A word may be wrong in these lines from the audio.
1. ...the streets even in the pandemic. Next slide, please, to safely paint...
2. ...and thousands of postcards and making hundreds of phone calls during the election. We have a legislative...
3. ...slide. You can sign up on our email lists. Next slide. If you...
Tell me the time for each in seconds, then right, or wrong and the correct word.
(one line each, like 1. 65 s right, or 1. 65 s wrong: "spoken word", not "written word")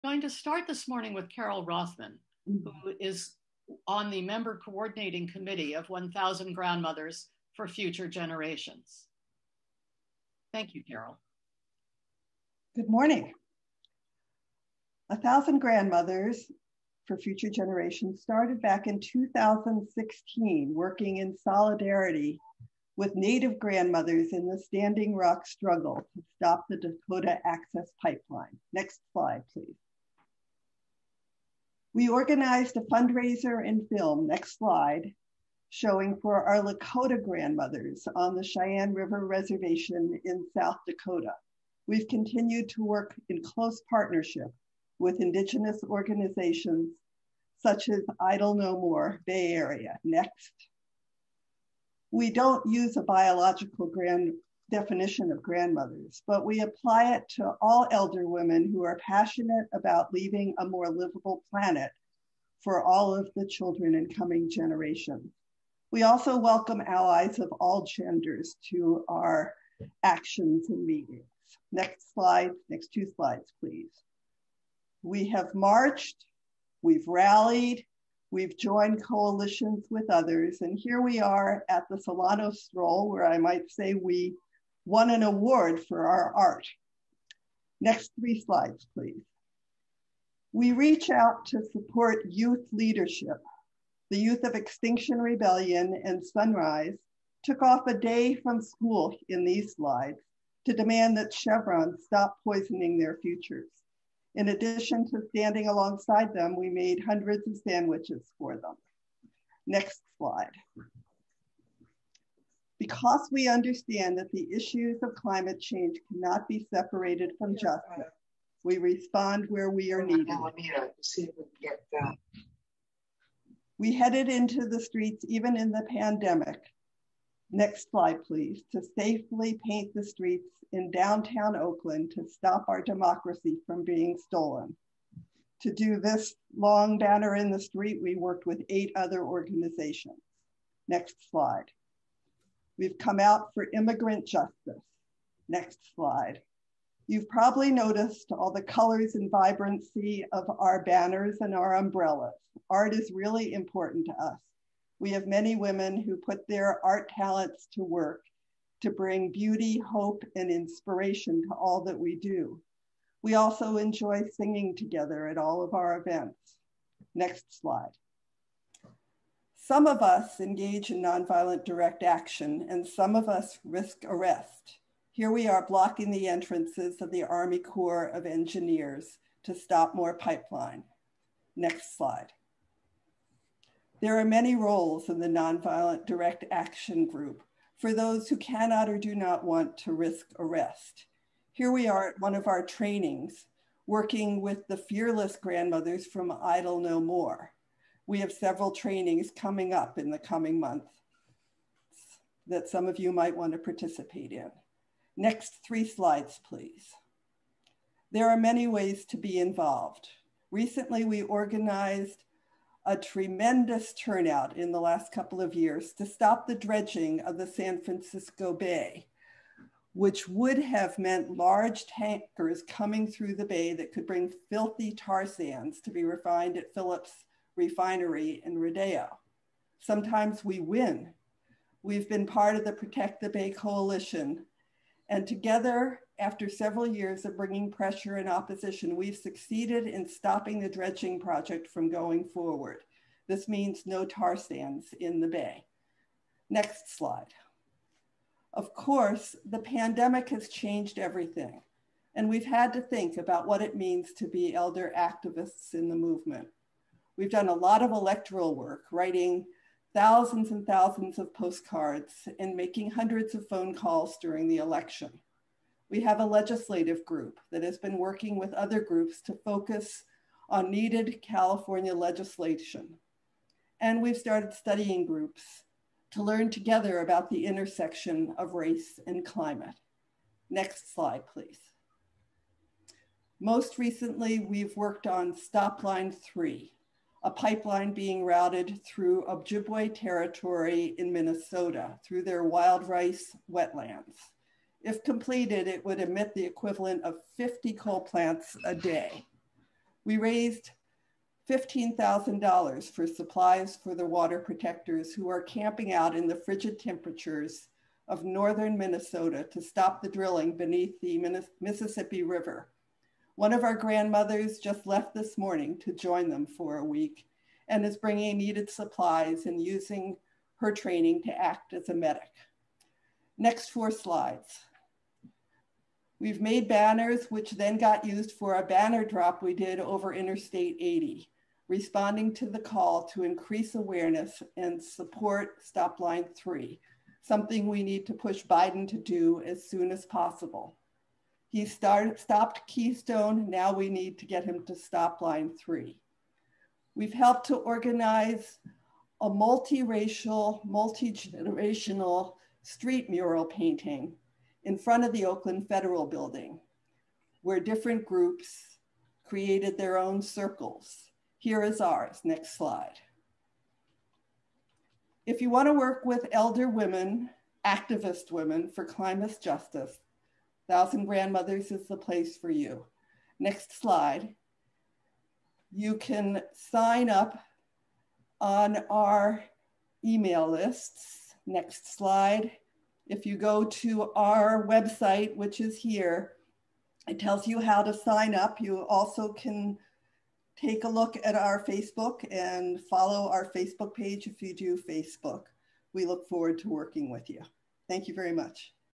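1. 124 s right
2. 260 s right
3. 373 s right.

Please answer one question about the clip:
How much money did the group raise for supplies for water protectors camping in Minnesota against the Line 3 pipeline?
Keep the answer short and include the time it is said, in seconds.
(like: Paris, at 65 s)
$15,000, at 301 s.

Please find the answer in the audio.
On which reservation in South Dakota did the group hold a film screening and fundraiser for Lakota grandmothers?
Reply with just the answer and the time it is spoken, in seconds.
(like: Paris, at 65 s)
Cheyenne River Reservation, at 38 s.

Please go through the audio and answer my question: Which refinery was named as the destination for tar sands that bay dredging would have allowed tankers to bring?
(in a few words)
Phillips refinery in Rodeo.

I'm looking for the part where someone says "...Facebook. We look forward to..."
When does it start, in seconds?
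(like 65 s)
394 s.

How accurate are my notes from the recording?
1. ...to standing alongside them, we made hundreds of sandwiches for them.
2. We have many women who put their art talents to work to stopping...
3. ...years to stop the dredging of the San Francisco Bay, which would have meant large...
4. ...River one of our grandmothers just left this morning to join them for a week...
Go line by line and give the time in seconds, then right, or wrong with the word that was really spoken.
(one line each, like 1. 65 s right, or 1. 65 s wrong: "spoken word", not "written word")
1. 105 s right
2. 154 s wrong: "bring", not "stopping"
3. 215 s right
4. 312 s right.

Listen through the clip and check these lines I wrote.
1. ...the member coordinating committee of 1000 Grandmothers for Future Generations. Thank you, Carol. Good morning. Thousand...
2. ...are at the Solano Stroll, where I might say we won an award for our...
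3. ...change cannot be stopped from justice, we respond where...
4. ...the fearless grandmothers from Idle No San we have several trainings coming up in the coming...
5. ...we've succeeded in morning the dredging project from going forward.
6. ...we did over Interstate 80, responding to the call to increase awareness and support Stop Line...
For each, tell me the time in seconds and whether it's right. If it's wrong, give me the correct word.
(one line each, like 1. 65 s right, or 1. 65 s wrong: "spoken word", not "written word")
1. 4 s right
2. 81 s right
3. 115 s wrong: "separated", not "stopped"
4. 194 s wrong: "More", not "San"
5. 238 s wrong: "stopping", not "morning"
6. 329 s right.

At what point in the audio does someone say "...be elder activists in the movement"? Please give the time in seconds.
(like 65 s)
254 s.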